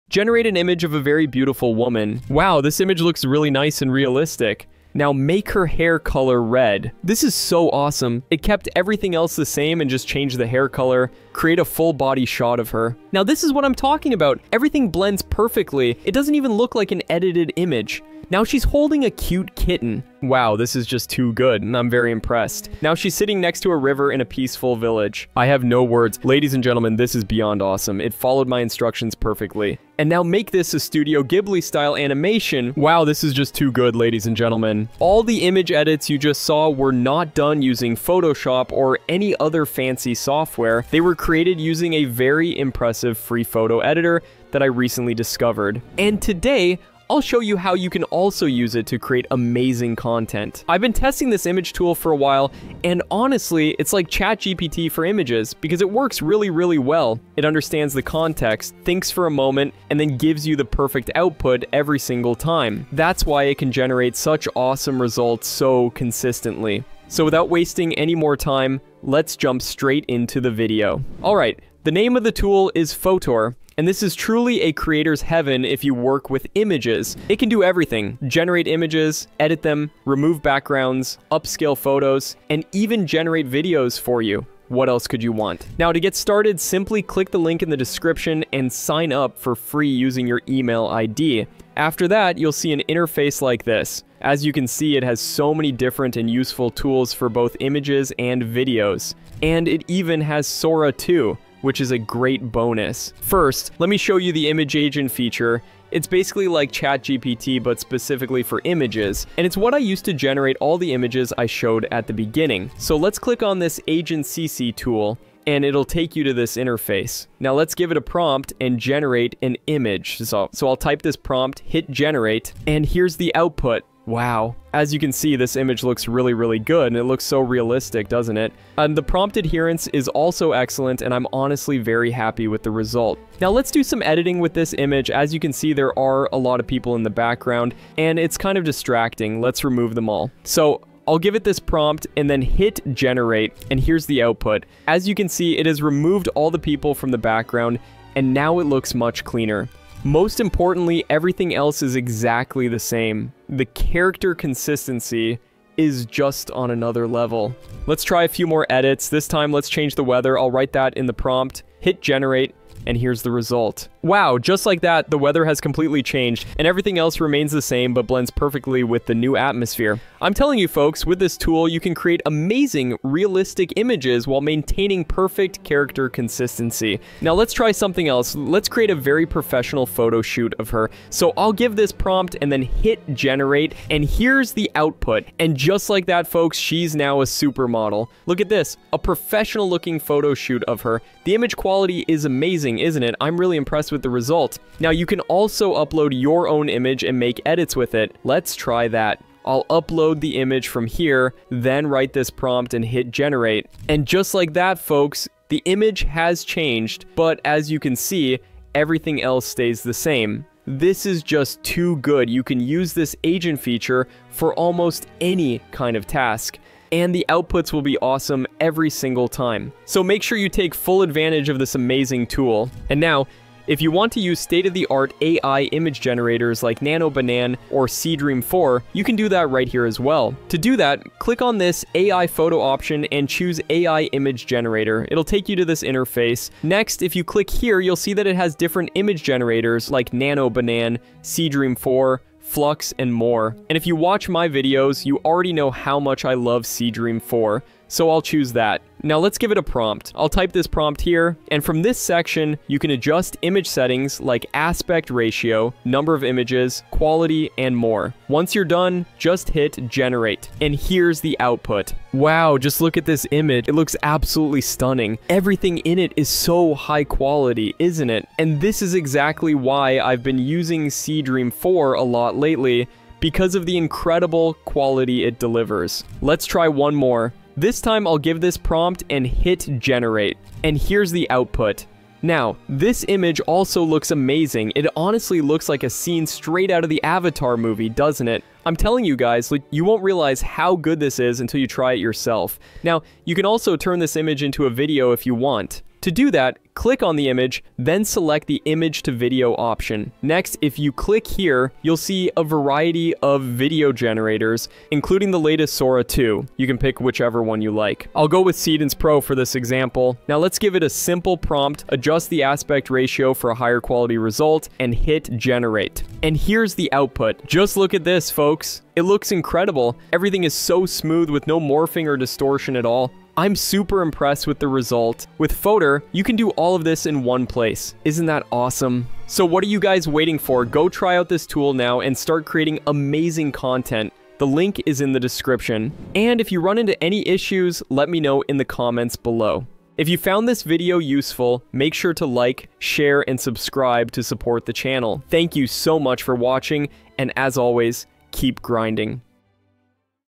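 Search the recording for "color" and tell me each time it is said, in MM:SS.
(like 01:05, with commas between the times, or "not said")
00:05, 00:10.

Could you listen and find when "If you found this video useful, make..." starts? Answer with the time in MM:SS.
05:39.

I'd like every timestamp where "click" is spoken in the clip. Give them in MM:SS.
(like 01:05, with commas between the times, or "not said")
01:27, 01:53, 03:51, 03:57, 04:56, 05:00.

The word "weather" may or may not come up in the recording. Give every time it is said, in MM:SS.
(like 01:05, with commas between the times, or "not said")
02:40, 02:45.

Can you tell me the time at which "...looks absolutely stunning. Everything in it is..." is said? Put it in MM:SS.
04:23.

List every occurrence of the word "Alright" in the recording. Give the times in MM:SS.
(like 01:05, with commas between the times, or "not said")
01:11.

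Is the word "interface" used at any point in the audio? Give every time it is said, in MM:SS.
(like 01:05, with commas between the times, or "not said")
01:32, 01:56, 03:55.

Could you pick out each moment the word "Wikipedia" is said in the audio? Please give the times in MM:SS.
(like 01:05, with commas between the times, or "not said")
not said.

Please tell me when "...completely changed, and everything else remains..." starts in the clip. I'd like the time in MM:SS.
02:45.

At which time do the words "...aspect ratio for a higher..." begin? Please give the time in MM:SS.
05:12.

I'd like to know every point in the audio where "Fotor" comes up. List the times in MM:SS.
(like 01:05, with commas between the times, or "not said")
01:12, 05:25.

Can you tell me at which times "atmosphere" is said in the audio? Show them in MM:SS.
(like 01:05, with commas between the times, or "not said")
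02:49.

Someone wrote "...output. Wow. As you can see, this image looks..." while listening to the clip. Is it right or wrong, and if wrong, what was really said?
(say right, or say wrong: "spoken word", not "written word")
right.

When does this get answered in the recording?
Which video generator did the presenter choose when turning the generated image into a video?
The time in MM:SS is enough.
05:08.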